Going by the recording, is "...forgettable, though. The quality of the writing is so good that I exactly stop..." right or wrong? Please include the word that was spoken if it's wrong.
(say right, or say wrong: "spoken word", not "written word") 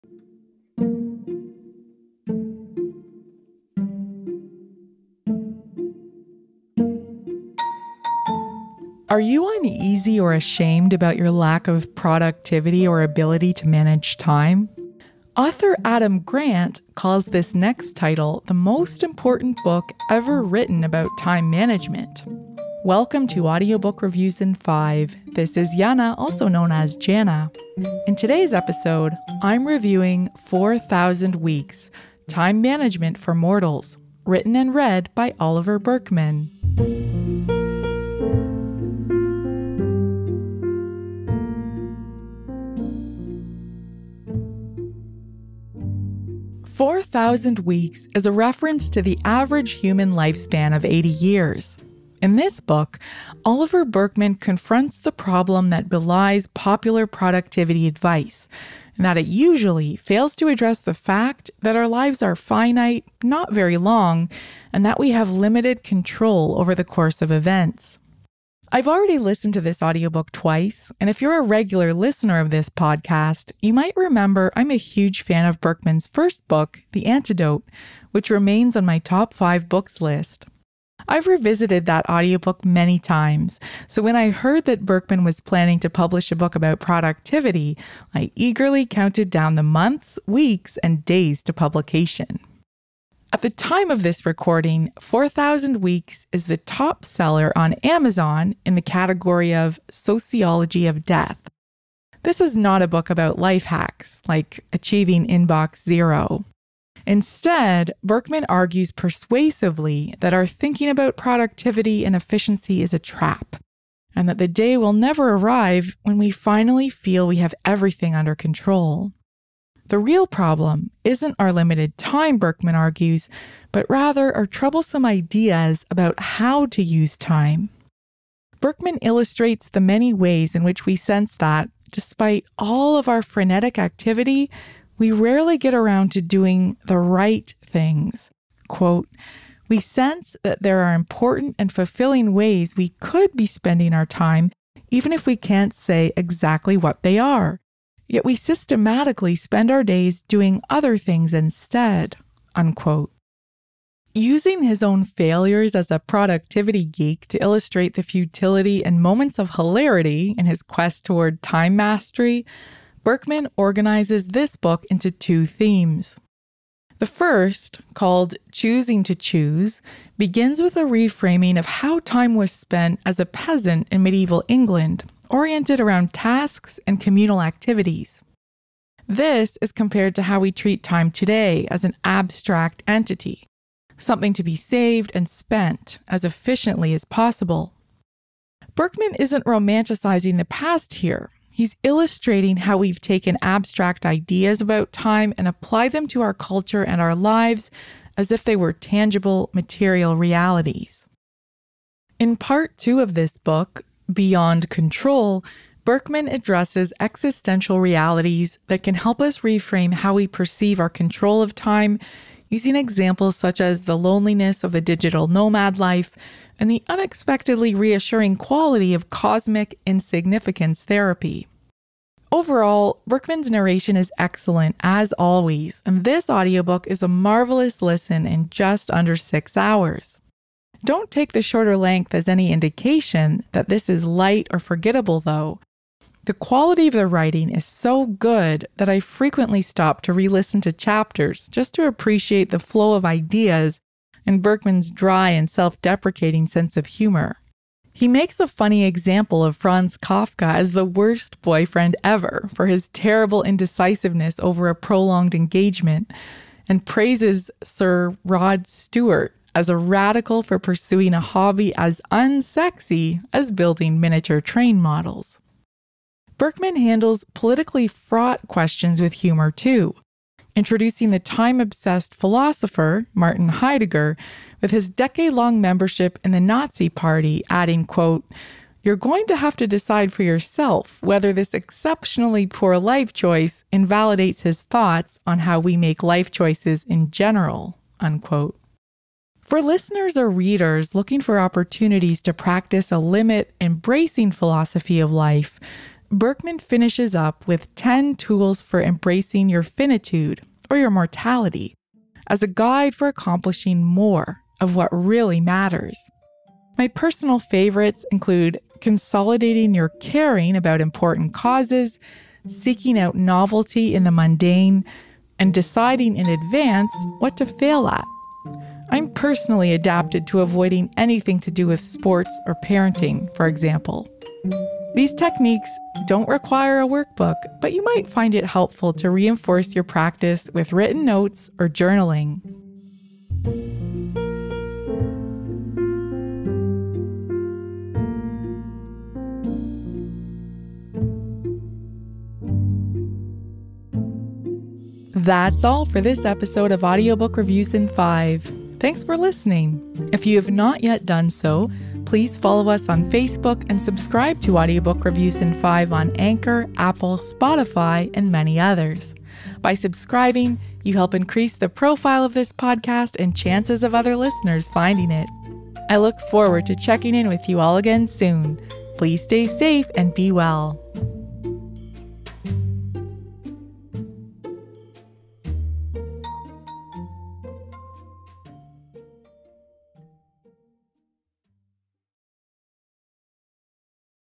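wrong: "frequently", not "exactly".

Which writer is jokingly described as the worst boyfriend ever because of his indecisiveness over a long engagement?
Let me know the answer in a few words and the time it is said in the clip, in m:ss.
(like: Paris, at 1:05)
Franz Kafka, at 4:09.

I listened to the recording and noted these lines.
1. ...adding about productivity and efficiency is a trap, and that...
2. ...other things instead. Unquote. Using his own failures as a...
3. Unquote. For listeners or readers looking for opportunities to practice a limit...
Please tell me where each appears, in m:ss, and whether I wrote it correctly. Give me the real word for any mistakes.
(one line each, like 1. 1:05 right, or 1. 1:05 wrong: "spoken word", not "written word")
1. 1:50 wrong: "thinking", not "adding"
2. 2:30 right
3. 4:47 right.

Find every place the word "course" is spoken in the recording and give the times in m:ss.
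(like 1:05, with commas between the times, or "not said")
1:06.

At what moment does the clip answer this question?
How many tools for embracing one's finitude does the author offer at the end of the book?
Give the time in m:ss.
4:57.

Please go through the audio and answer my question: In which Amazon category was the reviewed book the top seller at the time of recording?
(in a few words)
Sociology of Death.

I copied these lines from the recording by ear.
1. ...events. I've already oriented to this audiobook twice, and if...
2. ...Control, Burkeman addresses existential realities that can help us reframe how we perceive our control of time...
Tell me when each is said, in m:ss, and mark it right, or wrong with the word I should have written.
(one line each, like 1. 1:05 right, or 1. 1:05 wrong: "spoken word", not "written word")
1. 1:07 wrong: "listened", not "oriented"
2. 3:24 right.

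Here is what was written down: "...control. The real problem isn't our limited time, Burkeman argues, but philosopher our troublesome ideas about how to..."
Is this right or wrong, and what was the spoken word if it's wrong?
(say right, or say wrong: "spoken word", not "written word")
wrong: "rather", not "philosopher".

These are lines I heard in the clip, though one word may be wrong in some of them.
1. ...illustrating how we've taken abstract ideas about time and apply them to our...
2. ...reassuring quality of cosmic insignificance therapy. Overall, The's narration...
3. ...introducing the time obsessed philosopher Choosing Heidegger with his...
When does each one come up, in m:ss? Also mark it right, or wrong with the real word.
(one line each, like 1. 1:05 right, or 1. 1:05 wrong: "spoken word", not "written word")
1. 3:11 right
2. 3:37 wrong: "Burkeman", not "The"
3. 4:30 wrong: "Martin", not "Choosing".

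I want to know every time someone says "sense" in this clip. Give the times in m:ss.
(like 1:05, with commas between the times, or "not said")
2:10, 2:19, 4:06.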